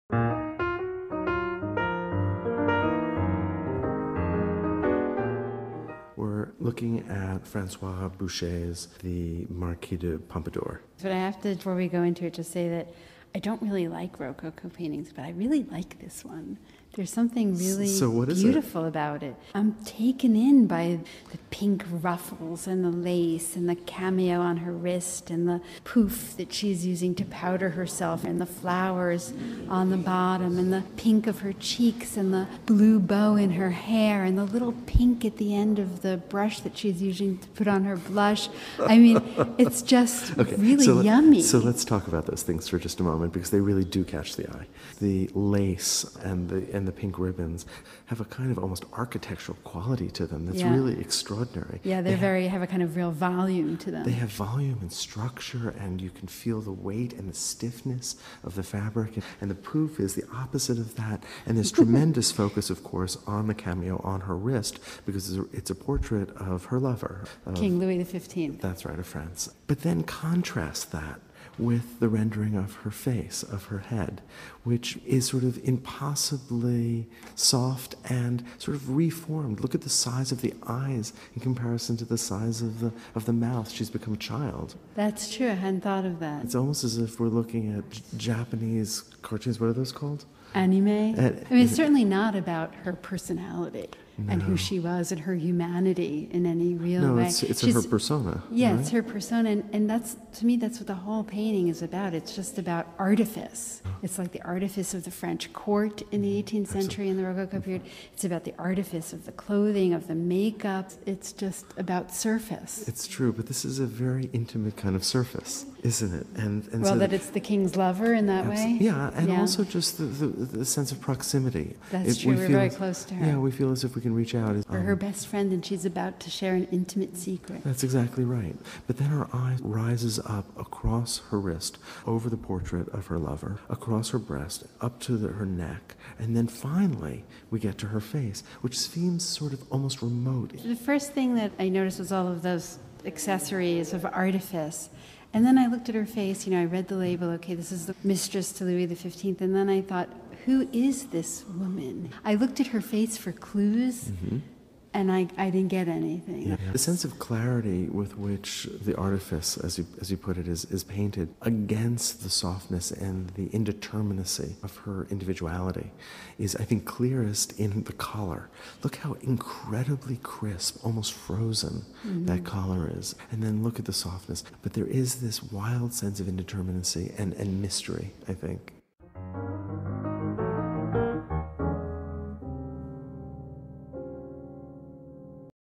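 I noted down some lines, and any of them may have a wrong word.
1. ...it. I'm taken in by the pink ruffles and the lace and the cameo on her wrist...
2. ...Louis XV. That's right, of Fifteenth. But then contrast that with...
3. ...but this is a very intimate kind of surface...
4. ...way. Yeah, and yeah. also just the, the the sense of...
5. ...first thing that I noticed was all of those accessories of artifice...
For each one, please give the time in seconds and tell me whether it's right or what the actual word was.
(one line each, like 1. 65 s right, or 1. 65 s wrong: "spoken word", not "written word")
1. 19 s right
2. 67 s wrong: "France", not "Fifteenth"
3. 113 s right
4. 118 s right
5. 140 s right.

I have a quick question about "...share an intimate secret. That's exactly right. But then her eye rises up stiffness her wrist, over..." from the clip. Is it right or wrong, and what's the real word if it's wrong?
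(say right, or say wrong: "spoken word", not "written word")
wrong: "across", not "stiffness".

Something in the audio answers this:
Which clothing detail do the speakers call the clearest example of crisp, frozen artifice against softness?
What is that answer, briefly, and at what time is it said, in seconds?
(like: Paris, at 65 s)
the collar, at 167 s.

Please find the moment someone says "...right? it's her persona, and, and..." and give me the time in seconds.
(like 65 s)
98 s.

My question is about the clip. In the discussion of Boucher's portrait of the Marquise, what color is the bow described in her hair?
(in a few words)
blue.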